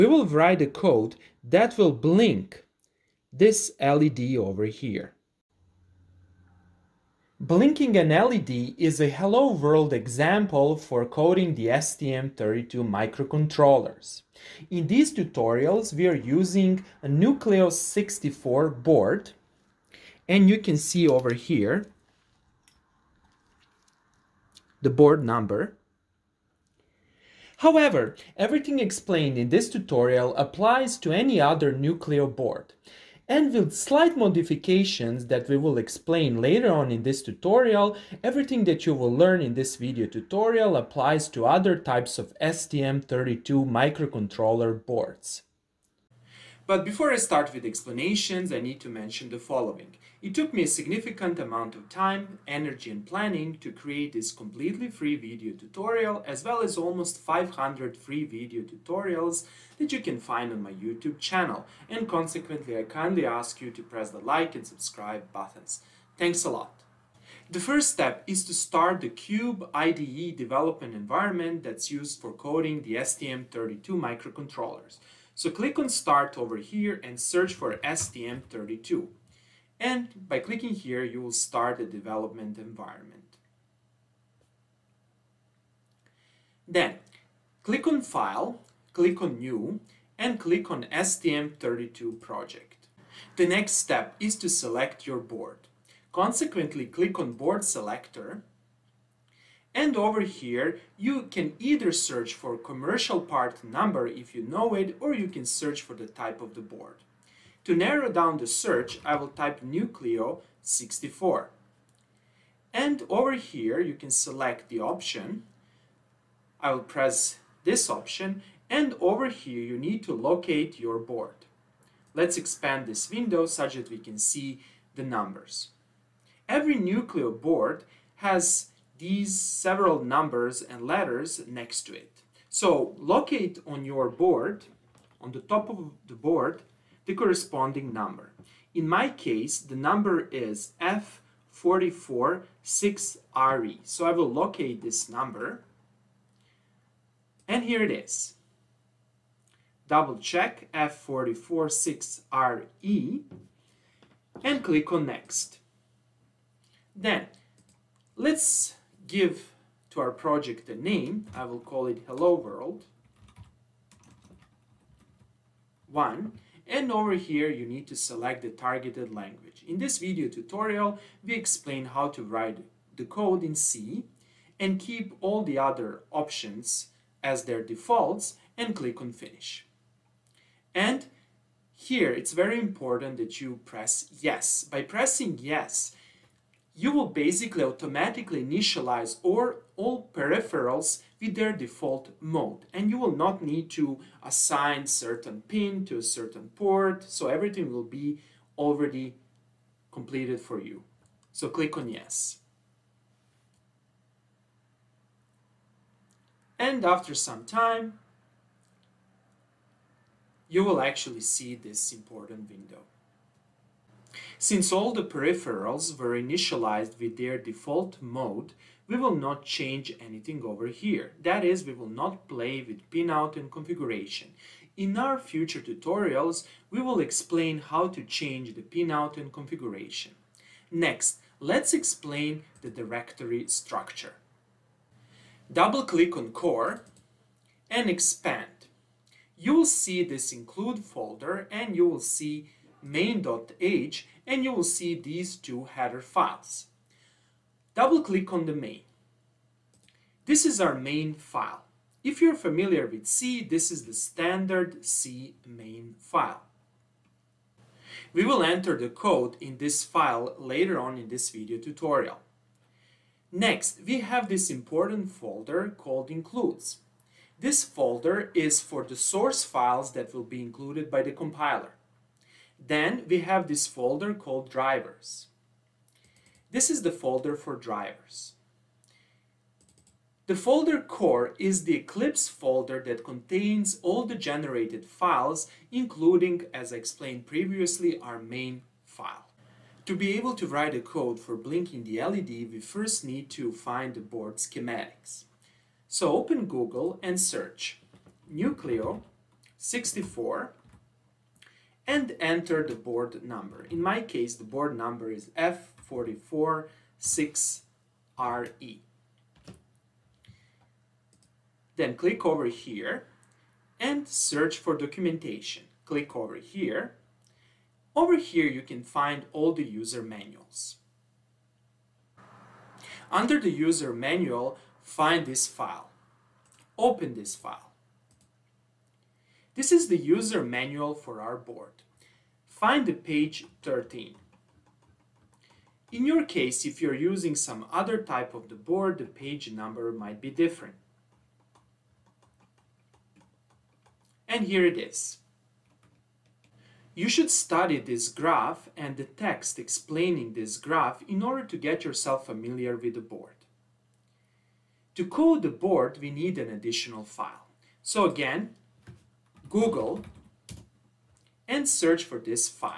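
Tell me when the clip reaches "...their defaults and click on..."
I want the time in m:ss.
2:57.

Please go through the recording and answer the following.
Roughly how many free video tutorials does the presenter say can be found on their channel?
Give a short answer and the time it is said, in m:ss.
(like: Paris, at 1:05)
500, at 0:57.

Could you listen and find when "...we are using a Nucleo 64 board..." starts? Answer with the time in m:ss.
0:15.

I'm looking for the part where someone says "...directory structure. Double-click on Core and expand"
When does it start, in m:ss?
3:52.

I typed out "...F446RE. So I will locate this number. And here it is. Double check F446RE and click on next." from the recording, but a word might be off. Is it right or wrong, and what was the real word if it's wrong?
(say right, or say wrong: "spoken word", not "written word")
right.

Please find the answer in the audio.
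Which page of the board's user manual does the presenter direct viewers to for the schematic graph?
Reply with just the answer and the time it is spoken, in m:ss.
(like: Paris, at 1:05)
13, at 5:33.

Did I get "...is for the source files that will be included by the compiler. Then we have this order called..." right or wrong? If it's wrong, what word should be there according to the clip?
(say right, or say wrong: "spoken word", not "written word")
wrong: "folder", not "order".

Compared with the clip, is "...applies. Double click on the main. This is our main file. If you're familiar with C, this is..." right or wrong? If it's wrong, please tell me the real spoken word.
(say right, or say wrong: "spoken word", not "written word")
wrong: "files", not "applies".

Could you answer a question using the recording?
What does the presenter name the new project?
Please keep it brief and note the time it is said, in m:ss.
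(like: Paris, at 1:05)
Hello World 1, at 2:42.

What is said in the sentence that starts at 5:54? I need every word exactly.
To code the board, we need an additional file.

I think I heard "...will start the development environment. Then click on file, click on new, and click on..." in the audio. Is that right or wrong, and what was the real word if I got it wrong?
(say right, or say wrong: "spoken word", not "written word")
right.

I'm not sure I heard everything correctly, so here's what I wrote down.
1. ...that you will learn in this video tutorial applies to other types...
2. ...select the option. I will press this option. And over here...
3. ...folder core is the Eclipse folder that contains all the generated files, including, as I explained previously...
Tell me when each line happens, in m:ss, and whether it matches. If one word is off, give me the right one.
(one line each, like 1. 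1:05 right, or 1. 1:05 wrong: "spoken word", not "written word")
1. 0:38 right
2. 1:54 right
3. 4:40 right.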